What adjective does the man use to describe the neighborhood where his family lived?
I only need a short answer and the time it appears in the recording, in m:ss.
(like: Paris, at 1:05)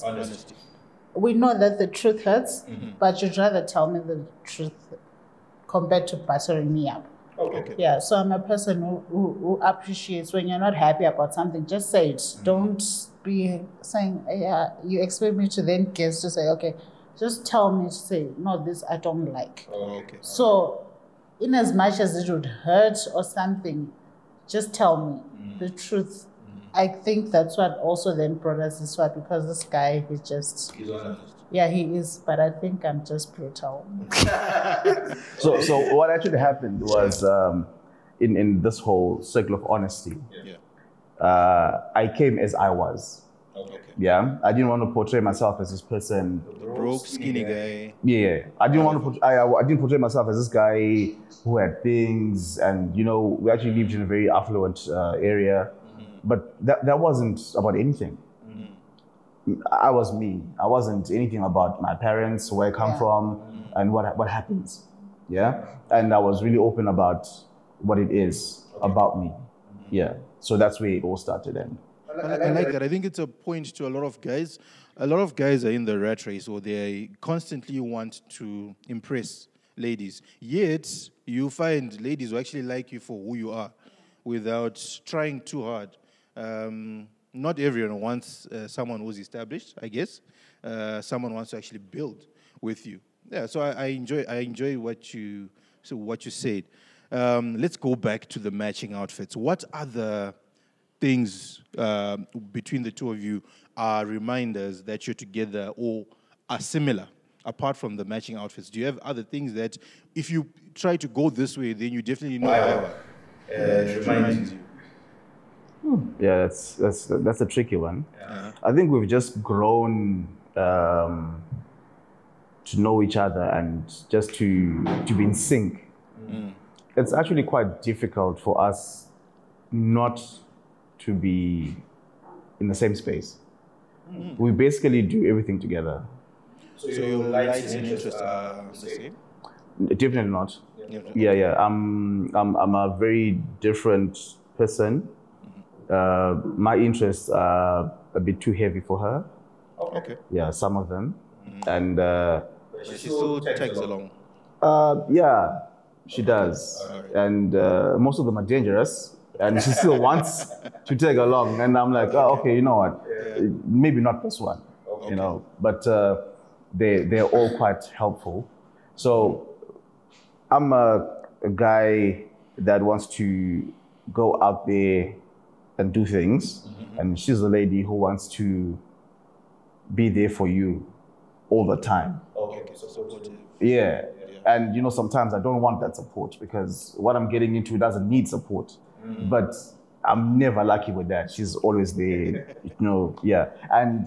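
affluent, at 0:54.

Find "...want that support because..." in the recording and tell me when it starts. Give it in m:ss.
3:05.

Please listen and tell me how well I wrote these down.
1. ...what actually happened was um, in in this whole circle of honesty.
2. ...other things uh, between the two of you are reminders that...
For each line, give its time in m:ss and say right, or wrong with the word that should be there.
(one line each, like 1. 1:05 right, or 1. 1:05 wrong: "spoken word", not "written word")
1. 0:35 right
2. 1:39 right.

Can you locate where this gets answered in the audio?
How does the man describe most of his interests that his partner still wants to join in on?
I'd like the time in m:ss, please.
2:38.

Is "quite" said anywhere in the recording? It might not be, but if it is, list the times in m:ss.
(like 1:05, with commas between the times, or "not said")
2:07, 2:47.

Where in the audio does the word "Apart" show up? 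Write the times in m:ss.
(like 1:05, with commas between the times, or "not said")
1:47.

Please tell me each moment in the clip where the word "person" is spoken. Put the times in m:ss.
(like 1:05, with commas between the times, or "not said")
0:08, 0:45, 2:24.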